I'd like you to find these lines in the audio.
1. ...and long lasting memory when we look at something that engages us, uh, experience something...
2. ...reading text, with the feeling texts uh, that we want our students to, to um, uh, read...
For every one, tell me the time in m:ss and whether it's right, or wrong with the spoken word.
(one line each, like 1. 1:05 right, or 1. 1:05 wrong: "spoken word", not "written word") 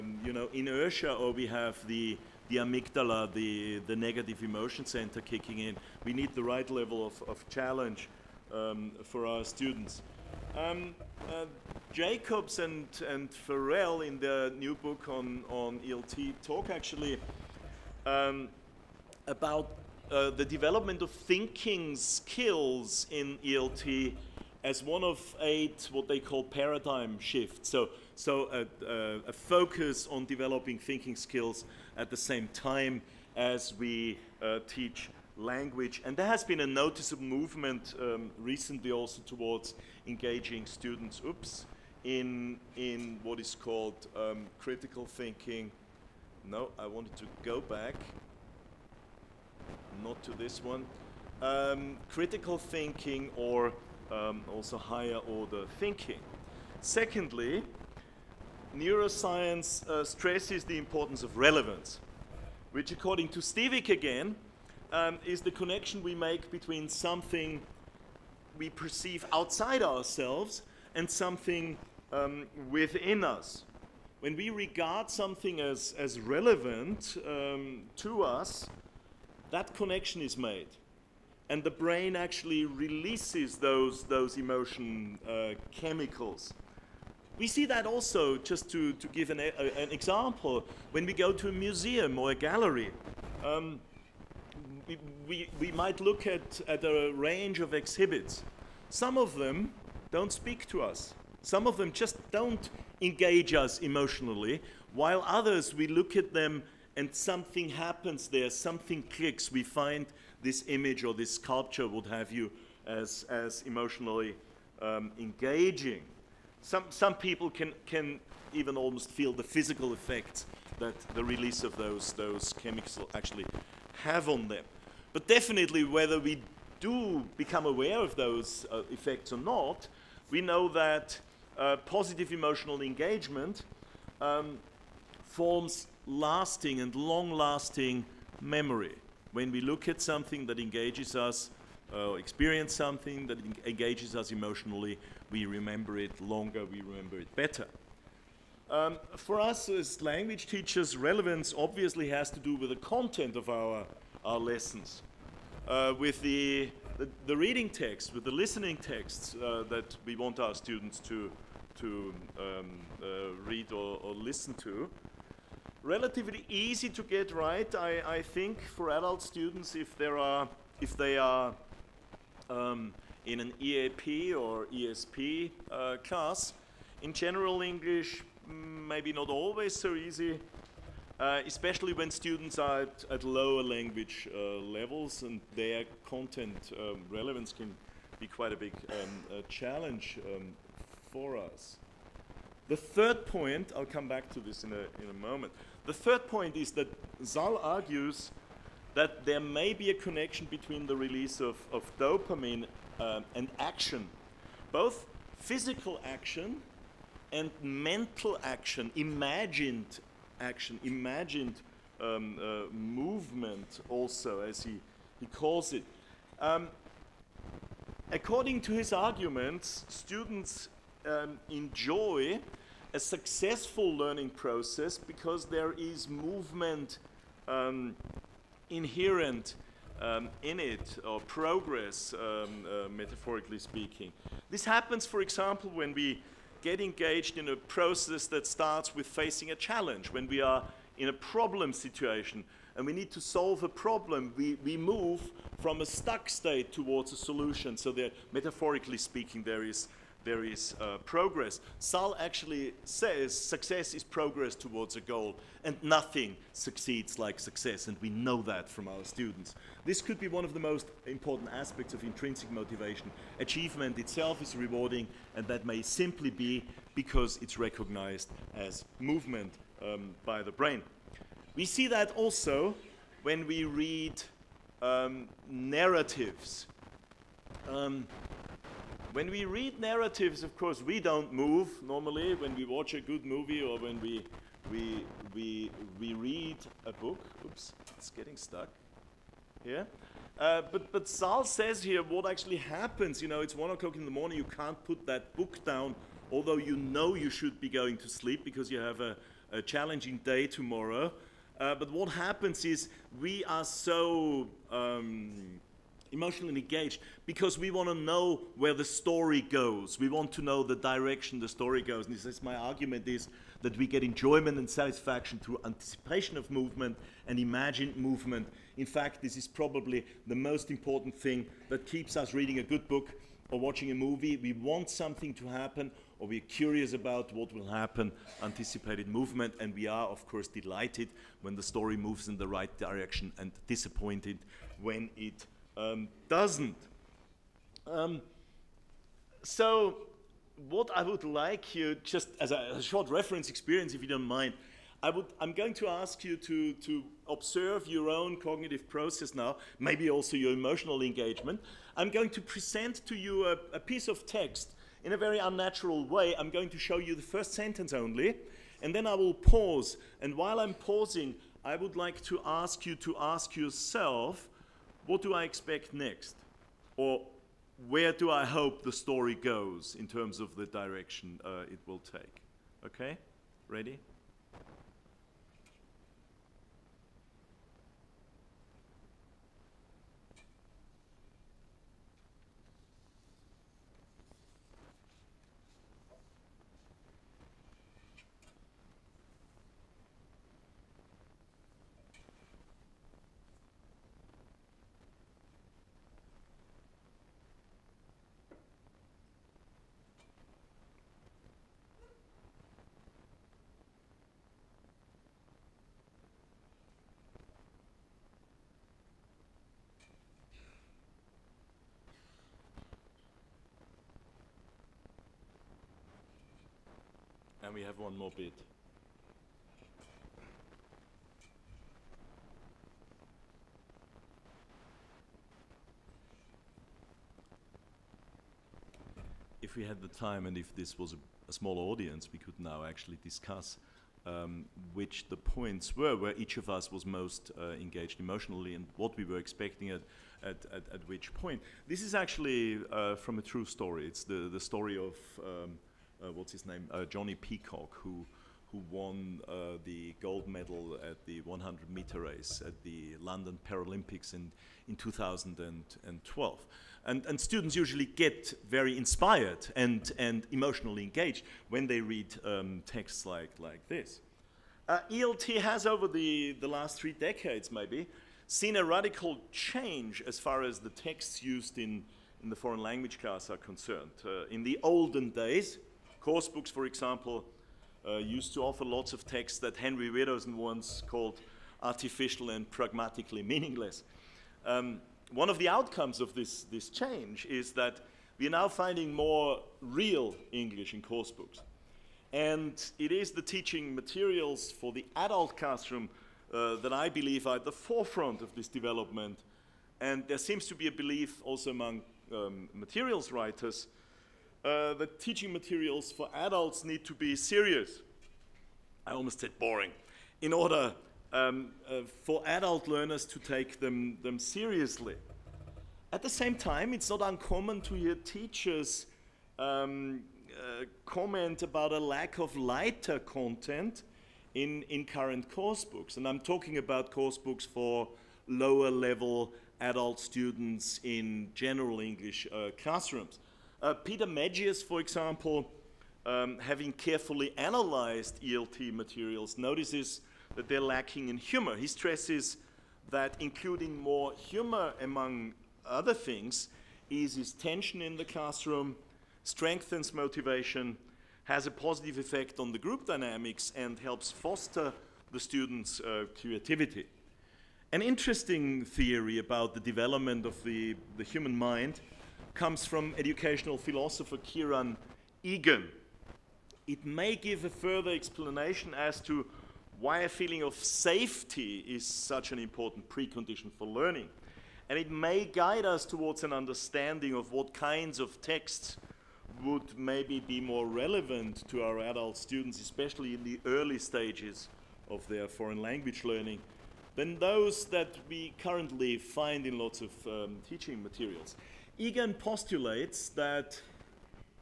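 1. 2:16 right
2. 2:37 wrong: "listening", not "feeling".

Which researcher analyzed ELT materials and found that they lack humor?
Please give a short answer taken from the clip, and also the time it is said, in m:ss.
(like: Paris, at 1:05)
Peter Medgyes, at 8:53.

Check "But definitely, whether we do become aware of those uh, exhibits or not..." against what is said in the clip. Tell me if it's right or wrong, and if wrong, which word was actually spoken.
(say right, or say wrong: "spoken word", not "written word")
wrong: "effects", not "exhibits".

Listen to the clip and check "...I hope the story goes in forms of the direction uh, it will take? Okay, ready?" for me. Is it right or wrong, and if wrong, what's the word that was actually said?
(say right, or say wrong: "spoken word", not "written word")
wrong: "terms", not "forms".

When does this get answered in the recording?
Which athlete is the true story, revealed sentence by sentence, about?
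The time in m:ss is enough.
7:27.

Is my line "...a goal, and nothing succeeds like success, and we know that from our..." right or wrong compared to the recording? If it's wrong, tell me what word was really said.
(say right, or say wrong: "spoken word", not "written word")
right.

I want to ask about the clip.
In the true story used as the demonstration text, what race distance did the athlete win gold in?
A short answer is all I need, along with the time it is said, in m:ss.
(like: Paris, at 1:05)
100 meters, at 7:31.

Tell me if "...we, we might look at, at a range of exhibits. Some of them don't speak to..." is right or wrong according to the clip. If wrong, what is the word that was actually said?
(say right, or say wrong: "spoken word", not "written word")
right.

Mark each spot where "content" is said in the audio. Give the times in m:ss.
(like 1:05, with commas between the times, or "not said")
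2:32, 3:06, 8:43.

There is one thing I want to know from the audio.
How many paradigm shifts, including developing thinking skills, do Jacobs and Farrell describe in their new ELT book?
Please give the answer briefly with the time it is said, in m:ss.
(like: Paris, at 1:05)
8, at 0:25.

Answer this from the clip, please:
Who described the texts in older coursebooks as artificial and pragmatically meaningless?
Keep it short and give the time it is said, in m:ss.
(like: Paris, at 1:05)
Henry Widdowson, at 7:59.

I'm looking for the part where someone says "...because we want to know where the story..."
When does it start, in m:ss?
5:07.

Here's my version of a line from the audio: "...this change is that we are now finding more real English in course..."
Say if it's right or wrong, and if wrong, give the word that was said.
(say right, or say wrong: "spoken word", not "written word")
right.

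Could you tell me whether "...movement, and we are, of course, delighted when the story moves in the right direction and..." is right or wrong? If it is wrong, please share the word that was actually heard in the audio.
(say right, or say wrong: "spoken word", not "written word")
right.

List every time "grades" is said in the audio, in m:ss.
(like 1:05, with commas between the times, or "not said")
not said.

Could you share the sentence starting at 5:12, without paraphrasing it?
And this is my argument is that we get enjoyment and satisfaction through anticipation of movement and imagined movement.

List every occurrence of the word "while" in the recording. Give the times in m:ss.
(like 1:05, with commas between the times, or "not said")
1:44, 6:00.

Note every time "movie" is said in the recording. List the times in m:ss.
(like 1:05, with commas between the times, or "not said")
4:43, 5:23.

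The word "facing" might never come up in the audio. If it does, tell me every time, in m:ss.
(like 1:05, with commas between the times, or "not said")
3:59.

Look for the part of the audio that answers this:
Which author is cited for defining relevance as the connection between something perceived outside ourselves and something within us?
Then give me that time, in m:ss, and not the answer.
1:03.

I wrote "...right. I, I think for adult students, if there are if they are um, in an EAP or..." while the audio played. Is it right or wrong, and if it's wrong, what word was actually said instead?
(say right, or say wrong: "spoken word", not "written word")
right.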